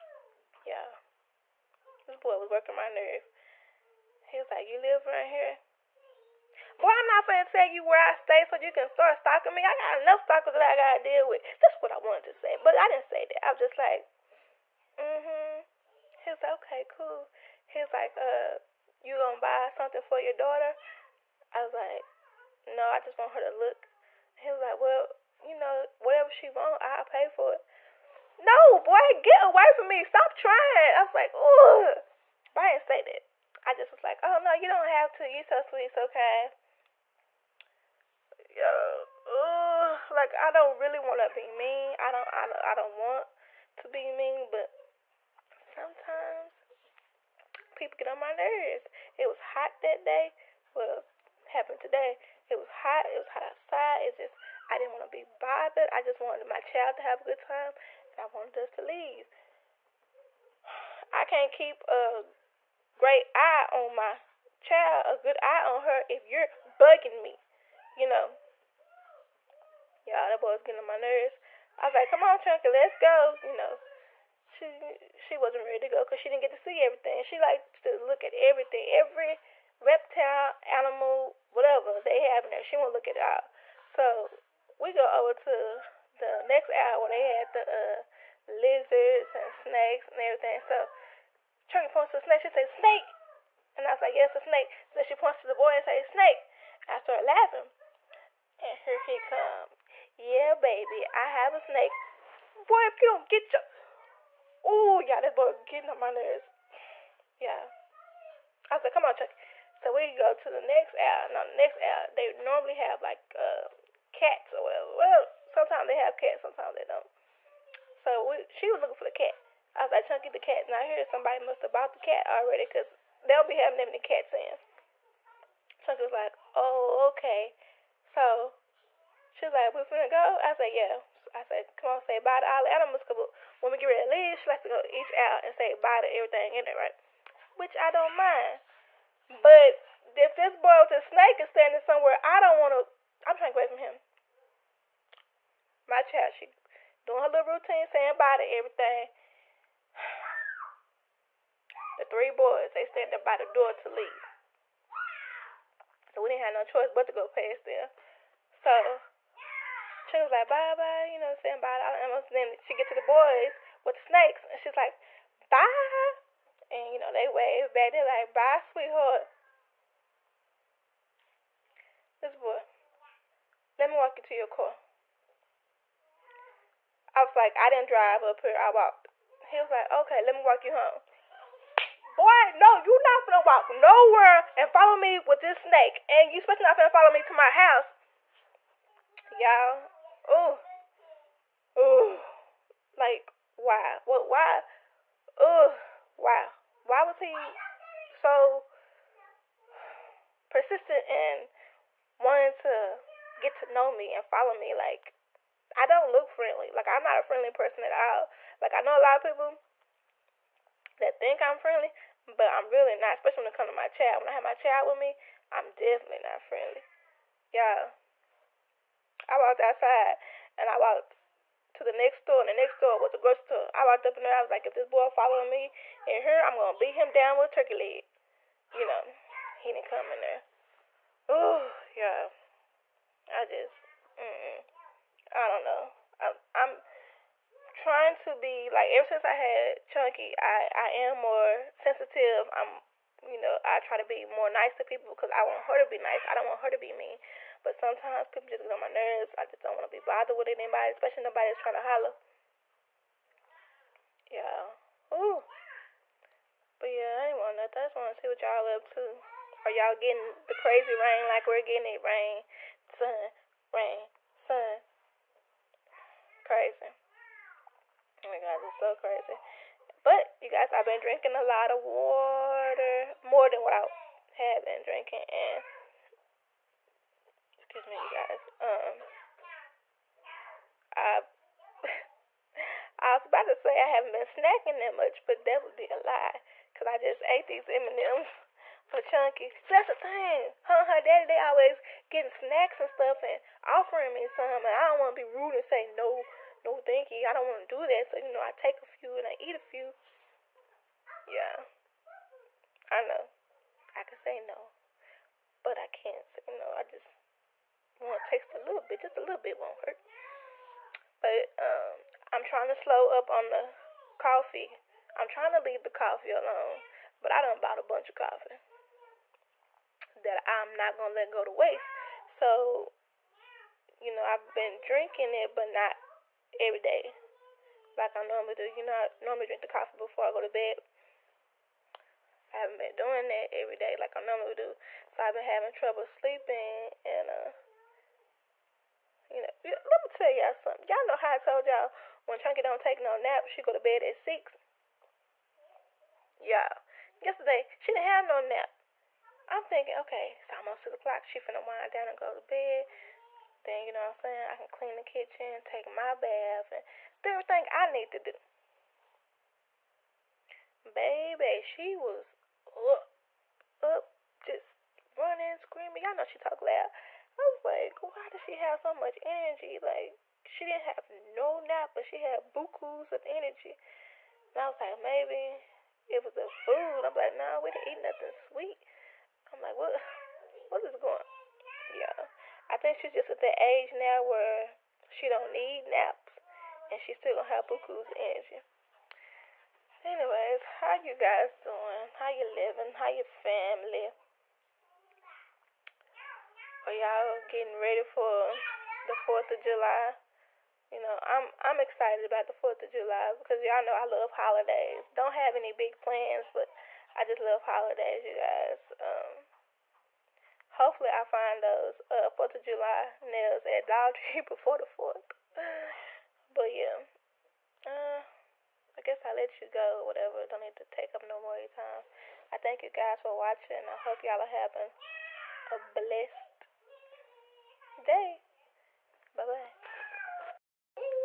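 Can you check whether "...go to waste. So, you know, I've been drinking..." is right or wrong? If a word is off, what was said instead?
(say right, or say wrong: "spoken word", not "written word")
right.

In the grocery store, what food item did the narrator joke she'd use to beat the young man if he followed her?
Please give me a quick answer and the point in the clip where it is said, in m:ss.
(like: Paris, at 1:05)
Turkey leg, at 3:47.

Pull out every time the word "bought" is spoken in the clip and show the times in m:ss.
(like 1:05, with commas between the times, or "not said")
2:01, 5:17.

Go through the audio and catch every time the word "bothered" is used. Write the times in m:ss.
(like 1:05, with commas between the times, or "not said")
0:55, 4:09.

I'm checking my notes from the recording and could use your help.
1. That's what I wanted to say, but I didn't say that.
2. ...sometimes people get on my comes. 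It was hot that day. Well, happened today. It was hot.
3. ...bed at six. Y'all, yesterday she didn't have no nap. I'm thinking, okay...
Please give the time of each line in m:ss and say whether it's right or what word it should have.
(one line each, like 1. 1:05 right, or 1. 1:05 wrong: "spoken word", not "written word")
1. 0:11 right
2. 0:45 wrong: "nerves", not "comes"
3. 5:43 right.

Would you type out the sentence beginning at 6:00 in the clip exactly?
Baby, she was up, up, just running, screaming.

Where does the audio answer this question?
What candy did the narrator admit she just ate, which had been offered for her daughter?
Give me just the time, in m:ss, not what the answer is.
4:47.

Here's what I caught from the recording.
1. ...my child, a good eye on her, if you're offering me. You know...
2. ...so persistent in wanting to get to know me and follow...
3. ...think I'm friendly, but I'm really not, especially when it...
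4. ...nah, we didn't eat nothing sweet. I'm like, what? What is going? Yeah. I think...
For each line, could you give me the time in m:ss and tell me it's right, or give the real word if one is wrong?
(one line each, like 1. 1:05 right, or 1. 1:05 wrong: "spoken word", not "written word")
1. 1:03 wrong: "bugging", not "offering"
2. 3:18 right
3. 3:31 right
4. 6:17 right.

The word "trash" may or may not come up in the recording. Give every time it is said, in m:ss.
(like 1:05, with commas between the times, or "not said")
not said.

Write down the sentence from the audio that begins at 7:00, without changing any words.
Don't need to take up no more of your time.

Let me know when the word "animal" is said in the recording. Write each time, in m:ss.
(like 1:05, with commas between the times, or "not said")
1:20, 2:12.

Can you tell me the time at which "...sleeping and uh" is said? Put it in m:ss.
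5:36.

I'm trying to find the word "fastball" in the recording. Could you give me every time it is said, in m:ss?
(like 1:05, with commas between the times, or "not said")
not said.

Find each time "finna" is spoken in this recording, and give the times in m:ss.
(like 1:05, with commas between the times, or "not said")
2:09, 5:51.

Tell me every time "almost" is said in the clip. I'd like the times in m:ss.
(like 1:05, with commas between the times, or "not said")
2:42, 5:50.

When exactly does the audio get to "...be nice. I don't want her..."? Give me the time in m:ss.
4:05.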